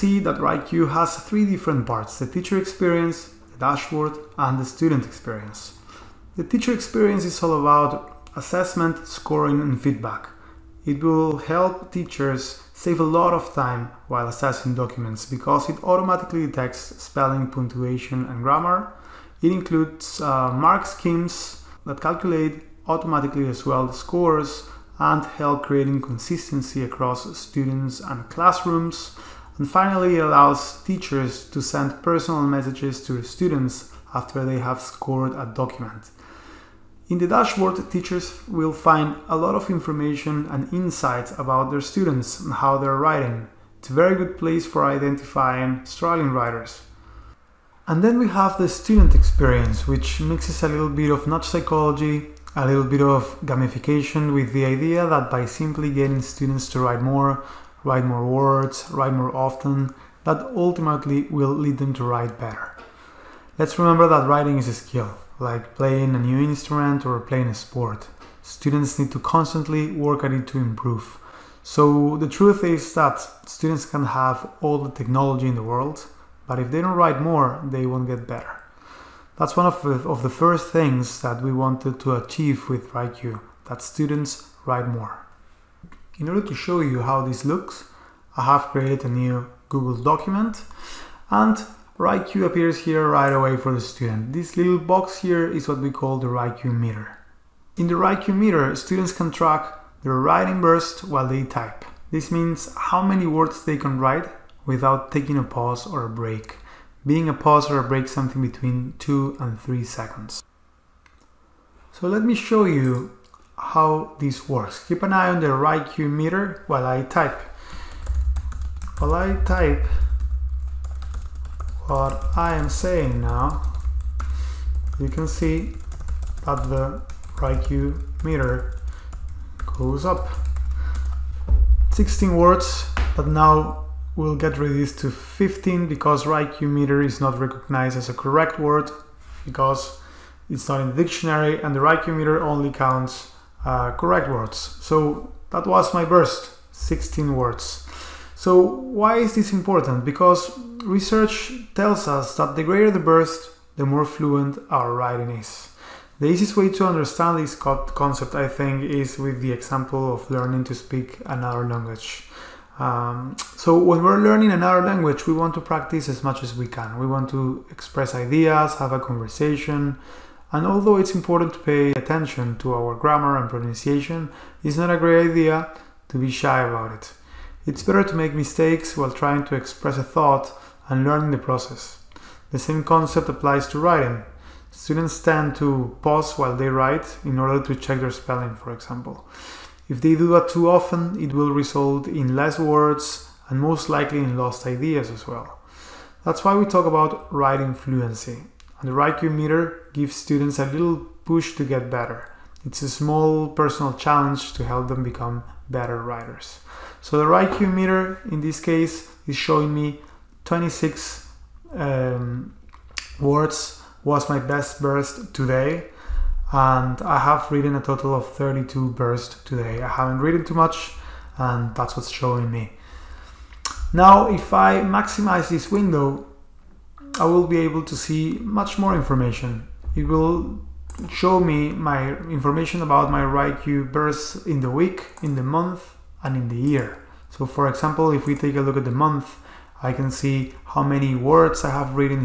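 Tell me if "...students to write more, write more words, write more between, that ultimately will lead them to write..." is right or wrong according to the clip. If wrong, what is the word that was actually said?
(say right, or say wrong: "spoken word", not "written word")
wrong: "often", not "between".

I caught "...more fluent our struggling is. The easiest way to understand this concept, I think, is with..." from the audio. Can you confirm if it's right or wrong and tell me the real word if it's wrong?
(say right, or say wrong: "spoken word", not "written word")
wrong: "writing", not "struggling".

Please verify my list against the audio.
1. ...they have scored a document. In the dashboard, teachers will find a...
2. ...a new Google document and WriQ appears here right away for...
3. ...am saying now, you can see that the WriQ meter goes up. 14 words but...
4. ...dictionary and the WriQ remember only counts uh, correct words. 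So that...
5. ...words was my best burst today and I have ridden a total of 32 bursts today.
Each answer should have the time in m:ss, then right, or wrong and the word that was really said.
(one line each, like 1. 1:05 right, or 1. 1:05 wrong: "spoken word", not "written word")
1. 0:34 right
2. 1:29 right
3. 2:02 wrong: "16", not "14"
4. 2:21 wrong: "meter", not "remember"
5. 3:33 right.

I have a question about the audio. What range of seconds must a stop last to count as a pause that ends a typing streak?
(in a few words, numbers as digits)
2 to 3 seconds.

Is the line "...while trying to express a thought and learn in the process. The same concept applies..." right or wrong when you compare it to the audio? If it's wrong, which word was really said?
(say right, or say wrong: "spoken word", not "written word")
right.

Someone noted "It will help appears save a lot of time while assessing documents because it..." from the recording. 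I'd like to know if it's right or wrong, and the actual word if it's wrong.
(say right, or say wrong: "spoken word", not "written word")
wrong: "teachers", not "appears".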